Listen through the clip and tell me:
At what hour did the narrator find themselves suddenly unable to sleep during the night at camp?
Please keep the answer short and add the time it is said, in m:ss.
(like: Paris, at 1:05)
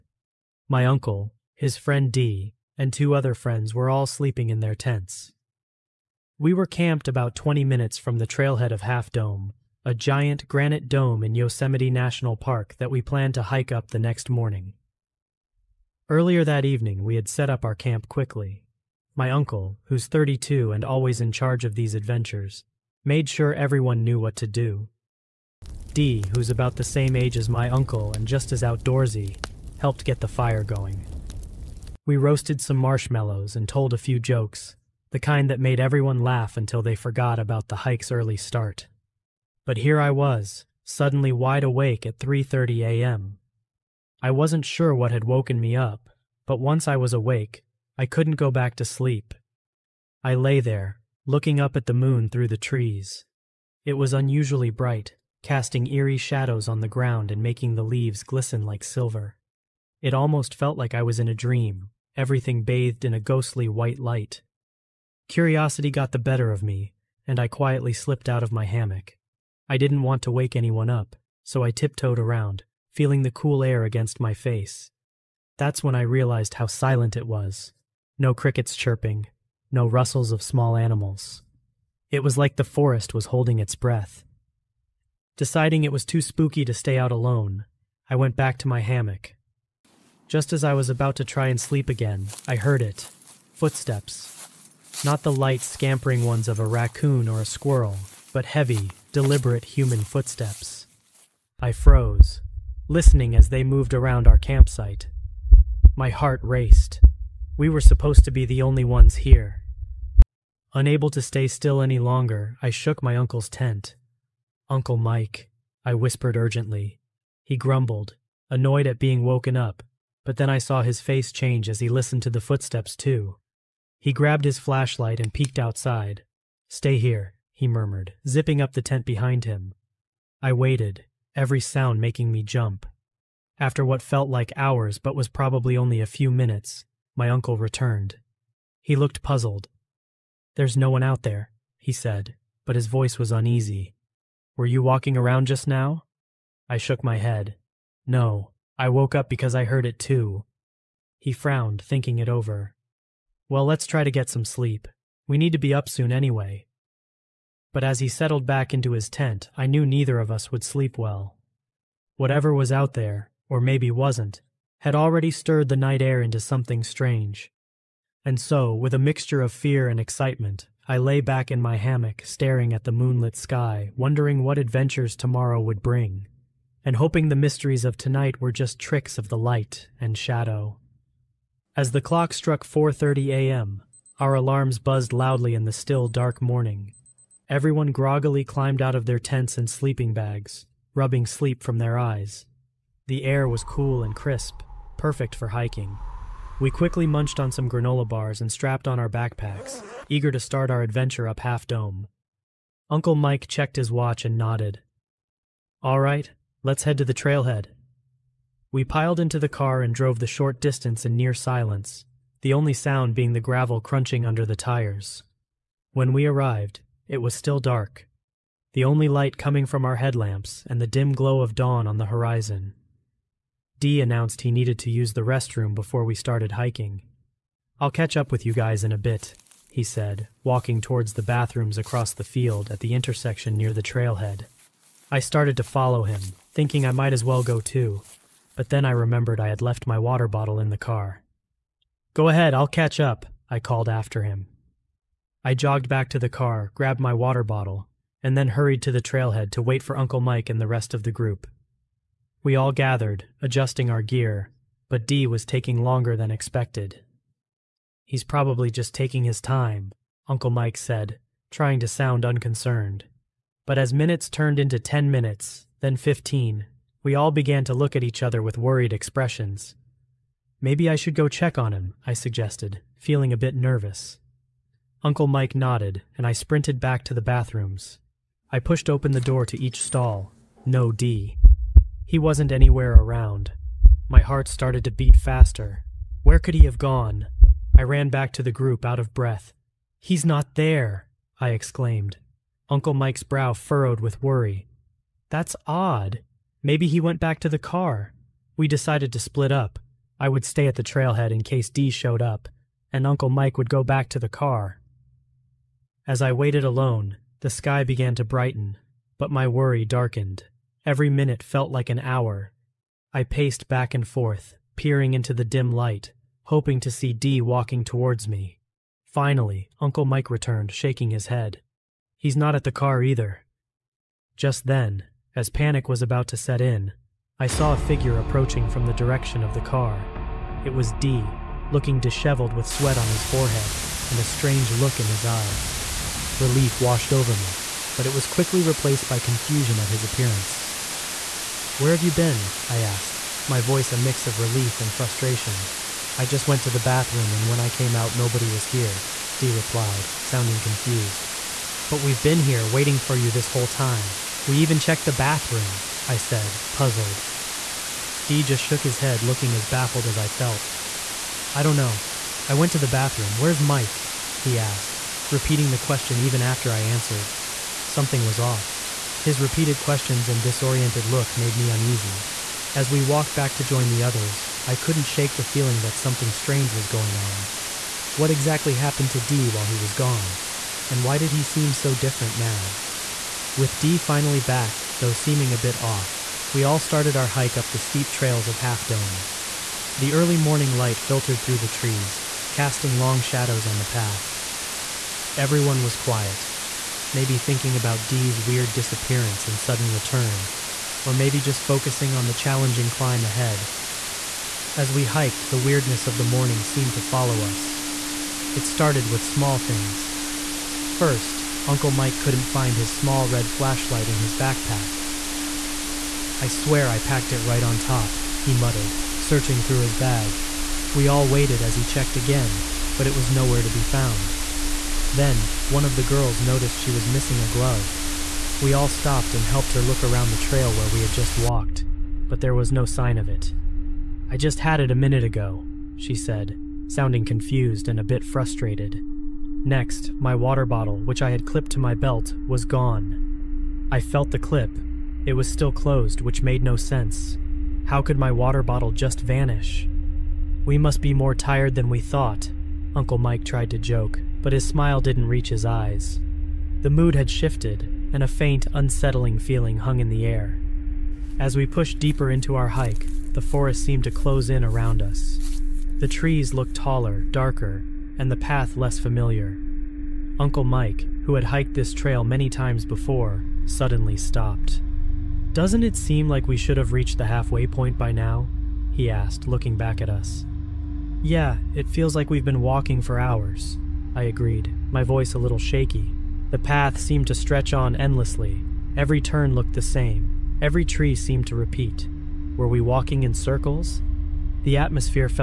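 3:30 a.m., at 0:42.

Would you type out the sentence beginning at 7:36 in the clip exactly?
The mood had shifted, and a faint, unsettling feeling hung in the air.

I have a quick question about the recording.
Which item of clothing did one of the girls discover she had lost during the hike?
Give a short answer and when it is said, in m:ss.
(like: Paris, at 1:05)
A glove, at 7:07.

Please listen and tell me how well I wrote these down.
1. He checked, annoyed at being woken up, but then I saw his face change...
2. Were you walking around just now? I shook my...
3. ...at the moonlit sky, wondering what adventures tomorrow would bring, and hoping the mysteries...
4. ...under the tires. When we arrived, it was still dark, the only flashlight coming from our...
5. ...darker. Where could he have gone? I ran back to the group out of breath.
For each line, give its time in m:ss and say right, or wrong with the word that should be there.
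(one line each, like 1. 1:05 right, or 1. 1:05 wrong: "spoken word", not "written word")
1. 1:57 wrong: "grumbled", not "checked"
2. 2:24 right
3. 2:52 right
4. 3:34 wrong: "light", not "flashlight"
5. 4:45 wrong: "faster", not "darker".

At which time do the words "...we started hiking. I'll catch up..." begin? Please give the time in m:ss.
3:46.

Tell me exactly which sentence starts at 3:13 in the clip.
The air was cool and crisp, perfect for hiking.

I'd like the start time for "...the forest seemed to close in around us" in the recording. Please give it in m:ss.
7:43.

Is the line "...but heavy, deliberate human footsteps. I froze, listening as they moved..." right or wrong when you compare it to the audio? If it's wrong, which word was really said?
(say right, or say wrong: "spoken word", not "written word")
right.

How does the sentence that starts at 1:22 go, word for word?
It was like the forest was holding its breath.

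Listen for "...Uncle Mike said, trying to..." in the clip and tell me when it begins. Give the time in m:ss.
4:20.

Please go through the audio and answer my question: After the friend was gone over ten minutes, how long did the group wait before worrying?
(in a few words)
15 minutes.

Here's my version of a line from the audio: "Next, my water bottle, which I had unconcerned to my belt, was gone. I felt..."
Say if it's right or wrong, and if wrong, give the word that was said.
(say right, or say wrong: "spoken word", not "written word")
wrong: "clipped", not "unconcerned".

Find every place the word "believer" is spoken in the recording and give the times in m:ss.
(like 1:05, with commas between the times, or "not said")
not said.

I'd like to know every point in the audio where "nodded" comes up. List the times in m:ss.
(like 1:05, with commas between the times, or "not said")
3:24, 4:35.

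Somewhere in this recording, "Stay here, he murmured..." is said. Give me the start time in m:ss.
2:06.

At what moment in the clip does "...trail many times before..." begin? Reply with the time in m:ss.
7:51.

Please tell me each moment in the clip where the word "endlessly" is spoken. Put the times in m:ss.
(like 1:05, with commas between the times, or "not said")
8:07.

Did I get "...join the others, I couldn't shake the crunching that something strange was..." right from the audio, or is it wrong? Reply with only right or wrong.
wrong.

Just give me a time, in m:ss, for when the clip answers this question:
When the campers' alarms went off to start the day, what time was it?
3:02.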